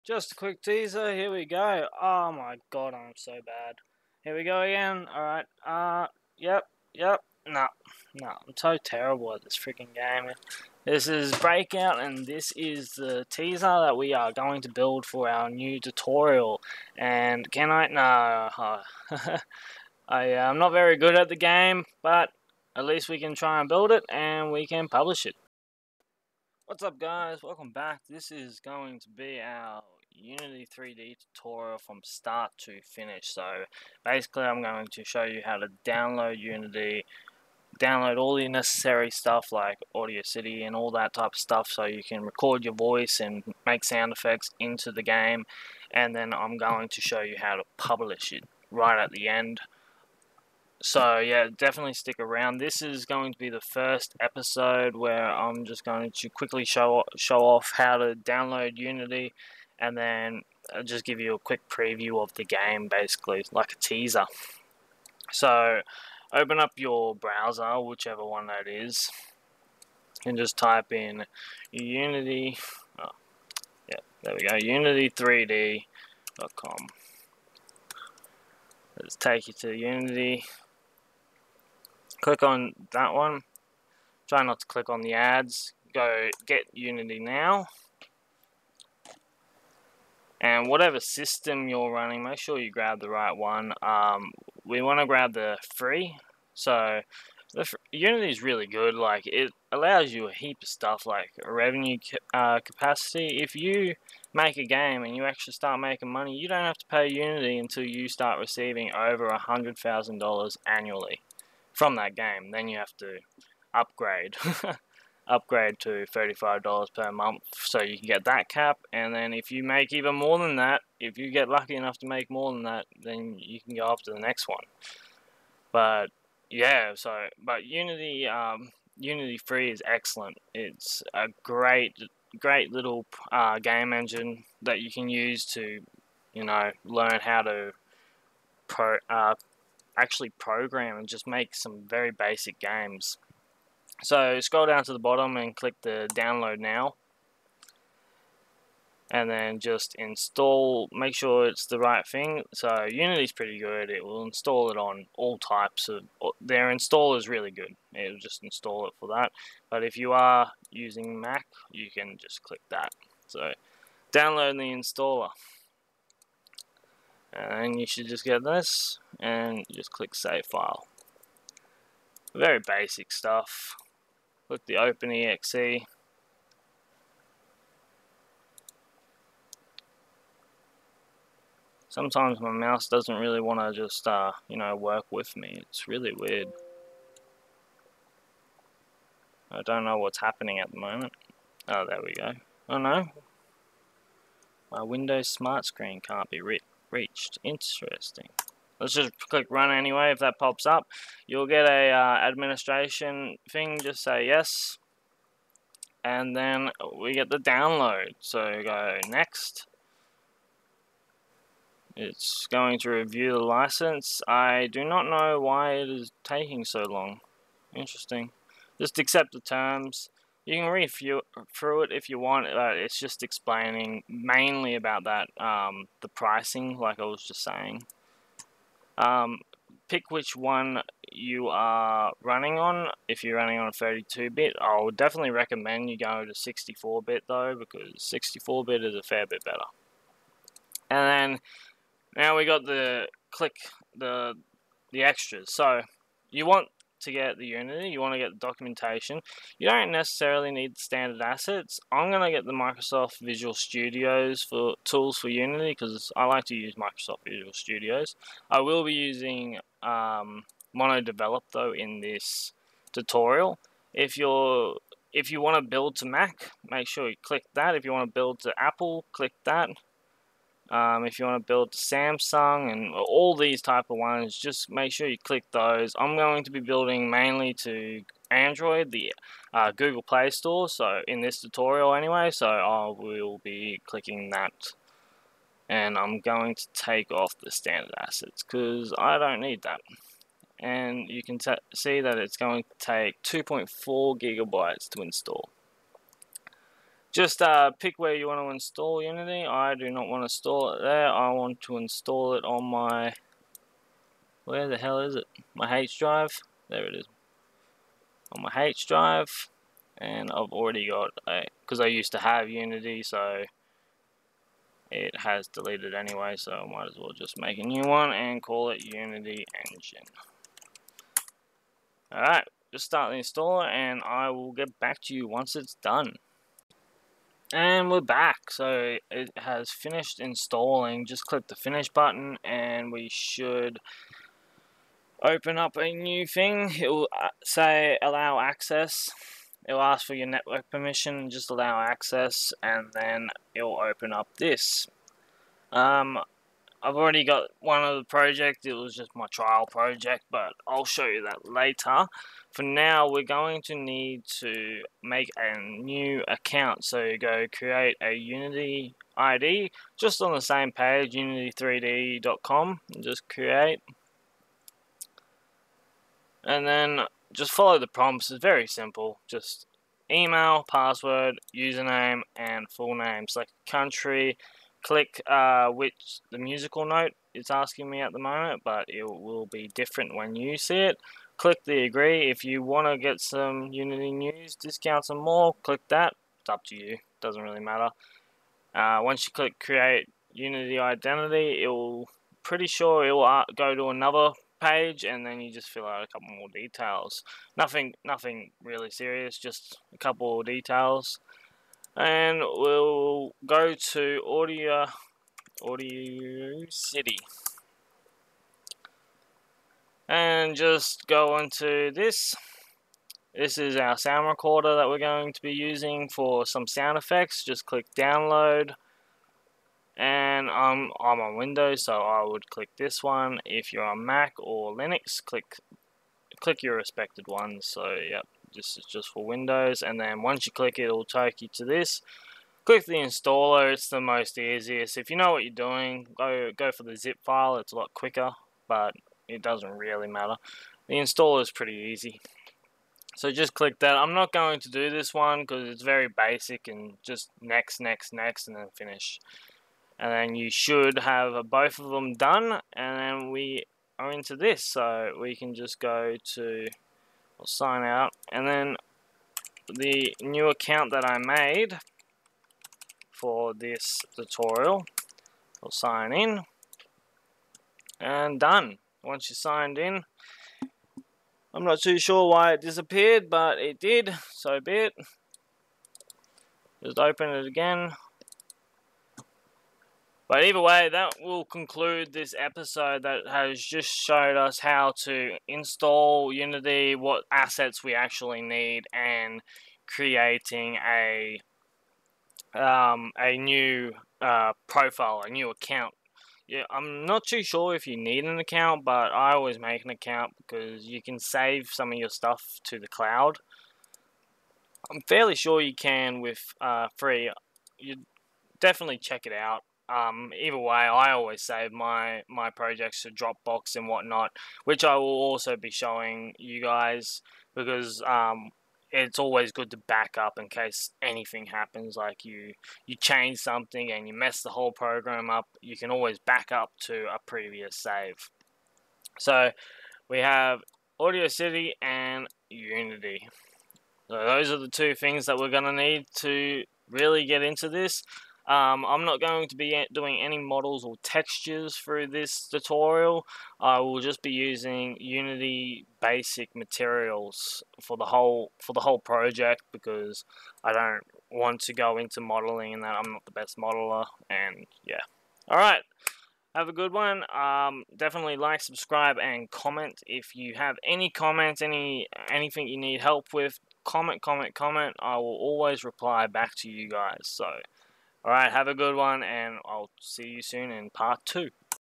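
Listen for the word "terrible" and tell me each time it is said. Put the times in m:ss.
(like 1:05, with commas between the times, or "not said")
0:08.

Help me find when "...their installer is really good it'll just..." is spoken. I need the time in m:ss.
2:36.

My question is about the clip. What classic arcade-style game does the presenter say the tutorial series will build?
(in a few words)
Breakout.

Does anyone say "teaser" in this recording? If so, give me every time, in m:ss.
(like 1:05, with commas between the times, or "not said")
0:00, 0:13, 1:03.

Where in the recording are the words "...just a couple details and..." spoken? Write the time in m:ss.
6:39.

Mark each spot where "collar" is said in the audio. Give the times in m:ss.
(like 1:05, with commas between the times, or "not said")
not said.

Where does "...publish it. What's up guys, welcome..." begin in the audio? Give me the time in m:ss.
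0:24.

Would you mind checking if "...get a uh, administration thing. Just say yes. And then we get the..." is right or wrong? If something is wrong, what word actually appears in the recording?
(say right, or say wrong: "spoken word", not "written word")
right.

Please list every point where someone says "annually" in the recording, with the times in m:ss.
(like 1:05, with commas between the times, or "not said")
1:50.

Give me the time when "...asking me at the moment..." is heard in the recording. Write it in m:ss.
6:17.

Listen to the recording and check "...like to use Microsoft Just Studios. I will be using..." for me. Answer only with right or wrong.
wrong.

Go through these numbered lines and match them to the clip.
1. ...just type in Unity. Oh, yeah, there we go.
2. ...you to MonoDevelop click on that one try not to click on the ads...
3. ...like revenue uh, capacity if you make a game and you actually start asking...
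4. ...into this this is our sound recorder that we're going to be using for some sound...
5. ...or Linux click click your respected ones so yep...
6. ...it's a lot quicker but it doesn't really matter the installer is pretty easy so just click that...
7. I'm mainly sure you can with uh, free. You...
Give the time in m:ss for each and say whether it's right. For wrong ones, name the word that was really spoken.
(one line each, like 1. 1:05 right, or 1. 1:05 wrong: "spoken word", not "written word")
1. 1:10 right
2. 1:19 wrong: "Unity", not "MonoDevelop"
3. 1:41 wrong: "making", not "asking"
4. 6:51 right
5. 7:04 right
6. 7:17 right
7. 8:24 wrong: "fairly", not "mainly".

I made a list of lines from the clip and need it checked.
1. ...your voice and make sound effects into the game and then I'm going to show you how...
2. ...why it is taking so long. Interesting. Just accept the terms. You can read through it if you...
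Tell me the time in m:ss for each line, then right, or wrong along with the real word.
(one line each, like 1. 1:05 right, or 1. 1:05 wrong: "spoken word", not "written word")
1. 0:42 right
2. 3:35 right.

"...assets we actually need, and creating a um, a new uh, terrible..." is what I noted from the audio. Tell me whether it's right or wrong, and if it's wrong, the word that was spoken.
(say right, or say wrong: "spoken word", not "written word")
wrong: "profile", not "terrible".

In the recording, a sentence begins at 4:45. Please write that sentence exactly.
And I'm going to take off the standard assets because I don't need that.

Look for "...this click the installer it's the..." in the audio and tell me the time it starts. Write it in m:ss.
7:11.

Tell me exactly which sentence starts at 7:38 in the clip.
And then the new account that I made for this tutorial, we'll sign in.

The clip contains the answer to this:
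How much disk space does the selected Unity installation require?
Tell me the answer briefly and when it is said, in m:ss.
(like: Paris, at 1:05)
2.4 gigabytes, at 4:53.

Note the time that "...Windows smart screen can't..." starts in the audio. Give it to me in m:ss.
3:14.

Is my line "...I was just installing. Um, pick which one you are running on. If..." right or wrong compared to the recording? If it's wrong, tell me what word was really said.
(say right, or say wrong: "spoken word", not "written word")
wrong: "saying", not "installing".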